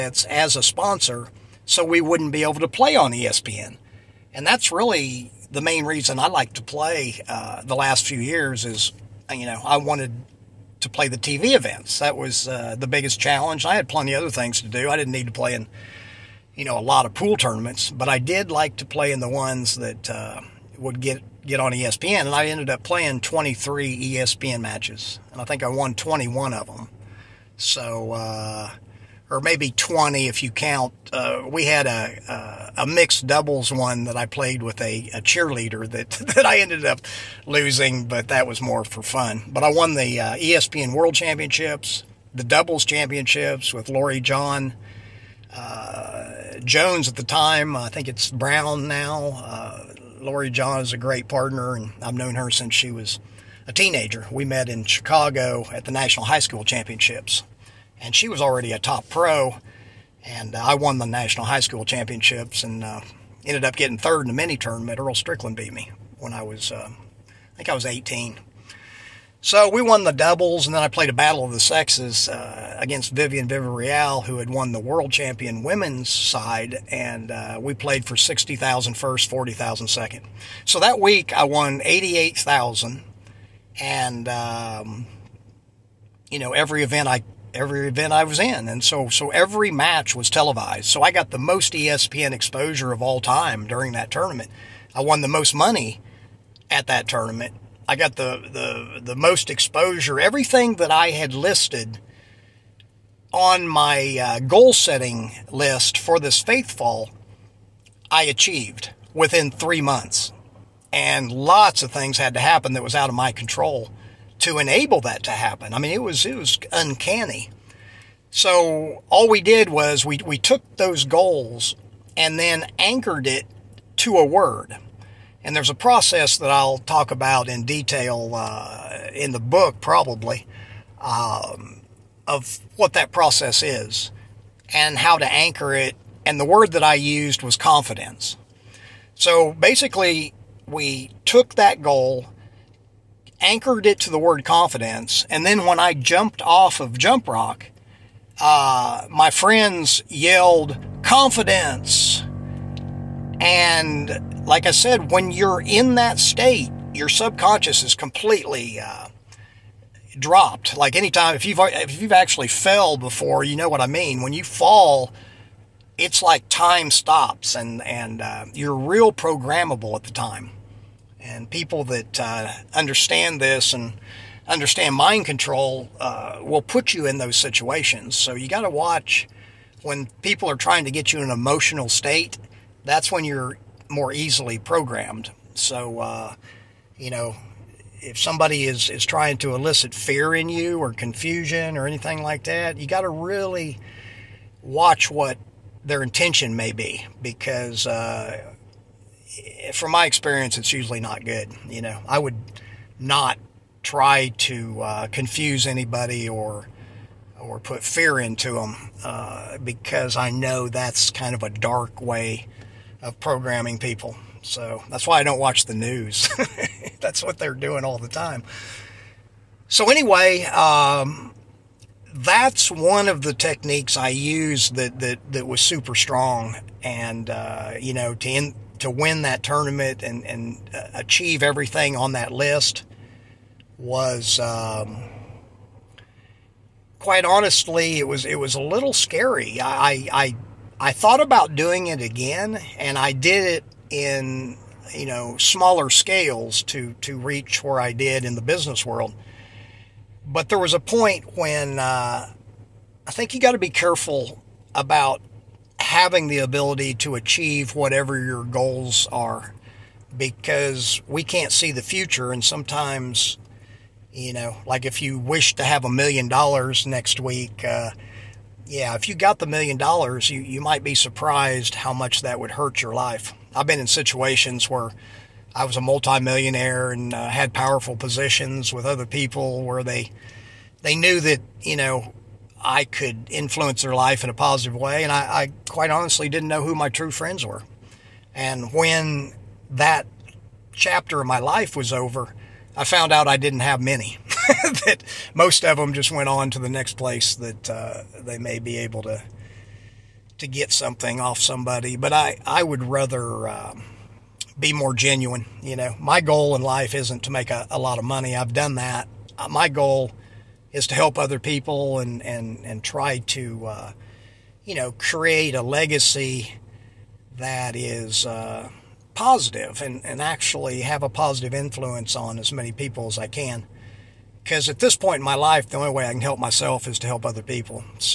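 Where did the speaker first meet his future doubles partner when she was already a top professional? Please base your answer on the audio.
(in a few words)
Chicago.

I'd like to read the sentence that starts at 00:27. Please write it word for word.
So, uh, or maybe 20 if you count.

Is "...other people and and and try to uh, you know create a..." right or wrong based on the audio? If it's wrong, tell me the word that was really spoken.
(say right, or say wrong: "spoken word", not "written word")
right.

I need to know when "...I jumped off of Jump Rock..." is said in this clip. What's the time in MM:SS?
02:25.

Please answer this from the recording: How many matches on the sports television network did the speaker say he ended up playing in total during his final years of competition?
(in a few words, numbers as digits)
23.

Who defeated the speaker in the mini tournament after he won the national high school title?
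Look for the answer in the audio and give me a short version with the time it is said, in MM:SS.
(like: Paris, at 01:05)
Earl Strickland, at 01:04.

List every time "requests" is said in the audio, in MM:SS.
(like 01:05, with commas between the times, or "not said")
not said.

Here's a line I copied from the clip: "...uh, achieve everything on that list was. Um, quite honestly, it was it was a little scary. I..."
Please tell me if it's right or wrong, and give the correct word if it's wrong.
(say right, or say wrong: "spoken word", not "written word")
right.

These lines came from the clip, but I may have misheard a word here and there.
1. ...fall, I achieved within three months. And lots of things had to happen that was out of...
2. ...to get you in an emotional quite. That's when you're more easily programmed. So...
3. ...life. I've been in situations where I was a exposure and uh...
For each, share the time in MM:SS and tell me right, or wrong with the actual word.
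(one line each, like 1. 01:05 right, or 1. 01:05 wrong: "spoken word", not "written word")
1. 01:46 right
2. 03:00 wrong: "state", not "quite"
3. 04:32 wrong: "multimillionaire", not "exposure".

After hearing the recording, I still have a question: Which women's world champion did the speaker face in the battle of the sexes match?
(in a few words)
Vivian Villarreal.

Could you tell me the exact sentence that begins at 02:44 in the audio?
When you fall, it's like time stops, and and uh, you're real programmable at the time.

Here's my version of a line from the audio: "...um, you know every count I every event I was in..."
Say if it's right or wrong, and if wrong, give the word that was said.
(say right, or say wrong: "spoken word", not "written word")
wrong: "event", not "count".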